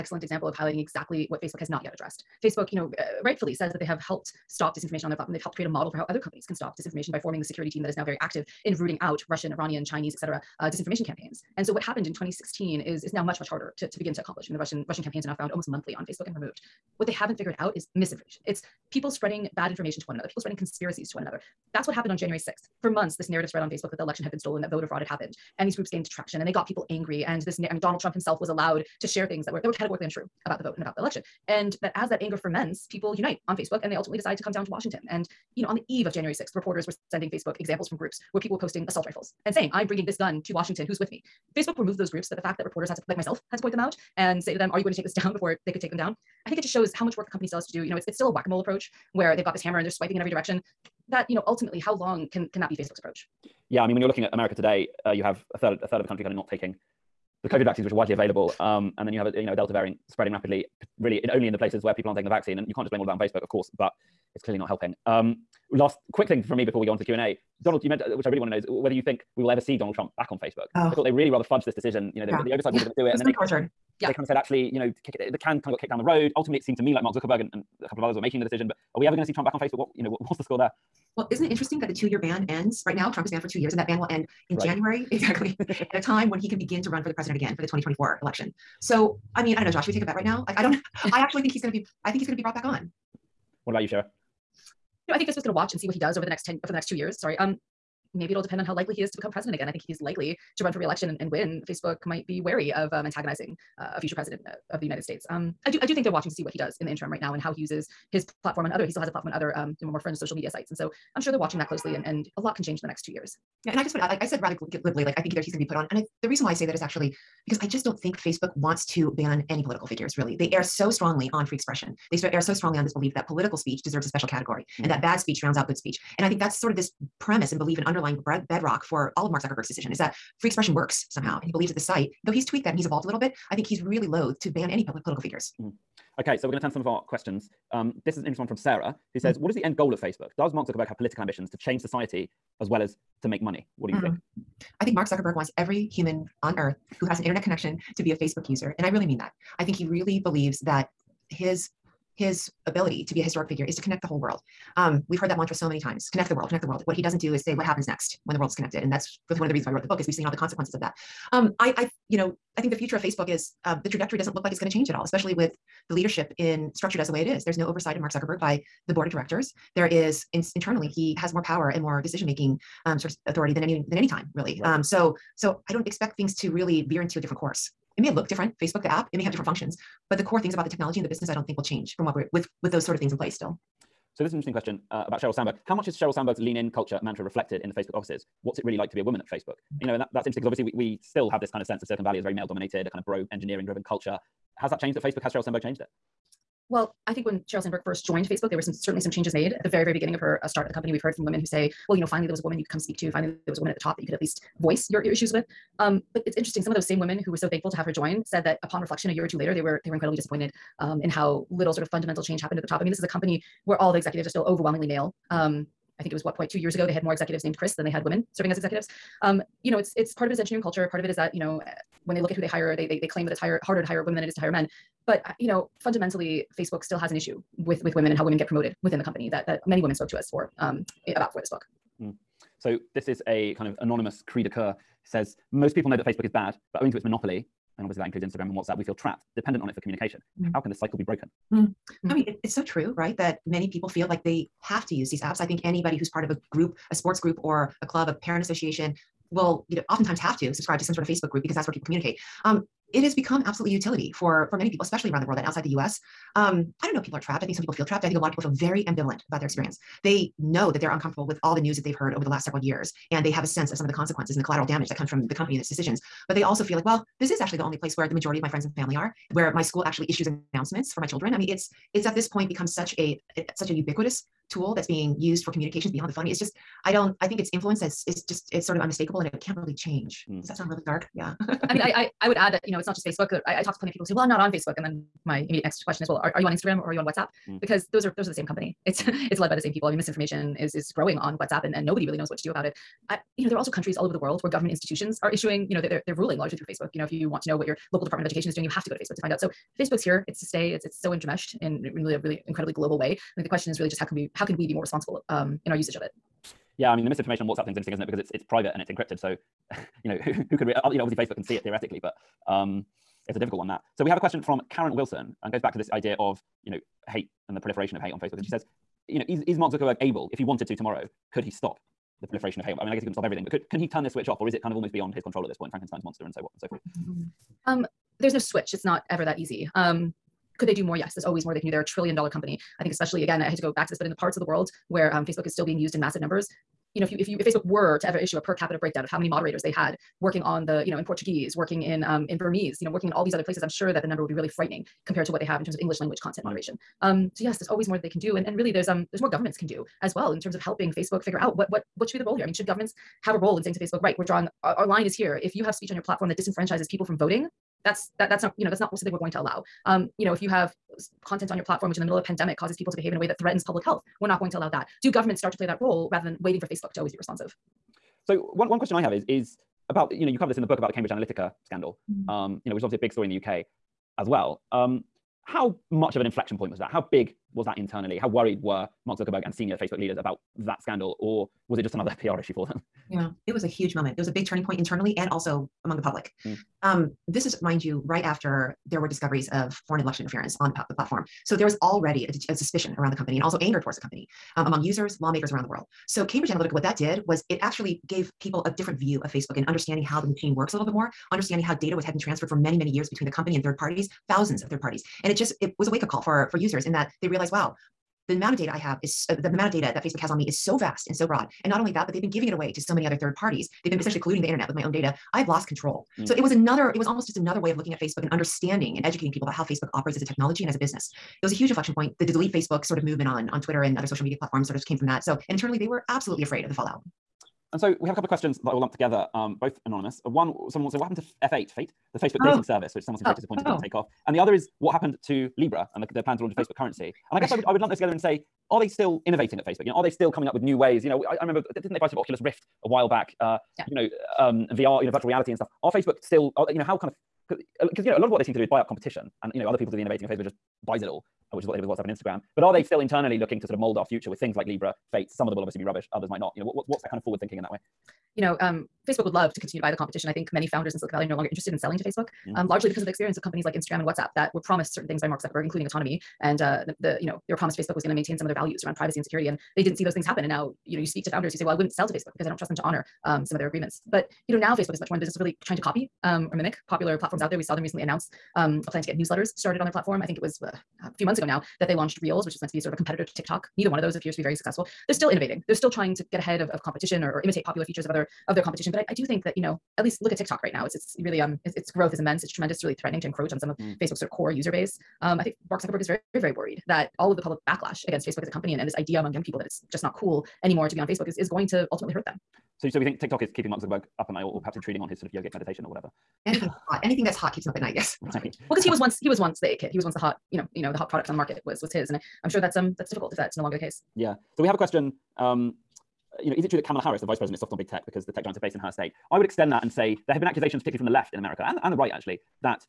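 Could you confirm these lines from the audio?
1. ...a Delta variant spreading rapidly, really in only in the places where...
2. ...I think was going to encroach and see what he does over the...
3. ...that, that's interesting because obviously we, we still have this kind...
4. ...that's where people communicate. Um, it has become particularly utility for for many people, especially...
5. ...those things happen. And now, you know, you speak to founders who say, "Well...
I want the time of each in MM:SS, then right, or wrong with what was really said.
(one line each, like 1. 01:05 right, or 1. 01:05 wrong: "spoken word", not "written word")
1. 00:59 right
2. 01:35 wrong: "watch", not "encroach"
3. 03:09 right
4. 04:11 wrong: "absolutely", not "particularly"
5. 07:50 right.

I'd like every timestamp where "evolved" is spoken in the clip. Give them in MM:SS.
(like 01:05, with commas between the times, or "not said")
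02:12.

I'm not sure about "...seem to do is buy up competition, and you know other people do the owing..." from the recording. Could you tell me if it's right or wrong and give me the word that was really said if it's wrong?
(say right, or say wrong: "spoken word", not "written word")
wrong: "innovating", not "owing".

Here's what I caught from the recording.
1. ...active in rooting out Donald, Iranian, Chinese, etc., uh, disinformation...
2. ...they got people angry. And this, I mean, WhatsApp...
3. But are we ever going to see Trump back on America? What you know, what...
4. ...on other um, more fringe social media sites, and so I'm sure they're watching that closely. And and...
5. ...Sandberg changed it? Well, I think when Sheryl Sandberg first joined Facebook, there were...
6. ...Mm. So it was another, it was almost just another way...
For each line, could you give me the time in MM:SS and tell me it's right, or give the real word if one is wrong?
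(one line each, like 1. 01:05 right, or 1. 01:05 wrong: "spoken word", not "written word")
1. 00:08 wrong: "Russian", not "Donald"
2. 00:26 wrong: "Donald", not "WhatsApp"
3. 01:18 wrong: "Facebook", not "America"
4. 01:49 right
5. 03:15 right
6. 06:56 right.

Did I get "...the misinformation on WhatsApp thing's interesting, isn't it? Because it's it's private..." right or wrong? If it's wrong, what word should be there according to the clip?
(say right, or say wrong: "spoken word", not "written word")
right.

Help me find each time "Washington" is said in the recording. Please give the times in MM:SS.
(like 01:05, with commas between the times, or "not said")
00:34, 00:40.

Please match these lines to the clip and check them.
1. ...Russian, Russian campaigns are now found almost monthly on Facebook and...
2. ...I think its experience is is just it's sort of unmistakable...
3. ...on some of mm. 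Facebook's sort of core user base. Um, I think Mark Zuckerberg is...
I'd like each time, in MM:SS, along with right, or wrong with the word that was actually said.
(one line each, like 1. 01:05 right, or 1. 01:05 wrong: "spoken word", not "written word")
1. 00:14 right
2. 04:37 wrong: "influence", not "experience"
3. 08:13 right.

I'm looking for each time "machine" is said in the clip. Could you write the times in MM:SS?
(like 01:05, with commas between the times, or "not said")
06:40.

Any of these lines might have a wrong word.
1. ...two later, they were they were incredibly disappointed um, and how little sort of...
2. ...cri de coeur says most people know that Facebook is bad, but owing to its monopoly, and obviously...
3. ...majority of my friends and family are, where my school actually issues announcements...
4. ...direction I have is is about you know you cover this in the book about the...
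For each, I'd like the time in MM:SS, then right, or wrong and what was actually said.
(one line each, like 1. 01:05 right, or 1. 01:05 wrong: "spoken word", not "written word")
1. 03:29 right
2. 03:54 right
3. 04:28 right
4. 06:08 wrong: "question", not "direction".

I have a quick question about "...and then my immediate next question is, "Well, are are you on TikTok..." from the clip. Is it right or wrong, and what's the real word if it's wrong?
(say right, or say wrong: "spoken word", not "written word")
wrong: "Instagram", not "TikTok".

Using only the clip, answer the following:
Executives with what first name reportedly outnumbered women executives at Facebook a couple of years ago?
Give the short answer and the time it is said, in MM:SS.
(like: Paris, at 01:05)
Chris, at 03:37.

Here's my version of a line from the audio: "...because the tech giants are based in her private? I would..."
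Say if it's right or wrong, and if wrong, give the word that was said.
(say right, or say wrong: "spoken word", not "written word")
wrong: "state", not "private".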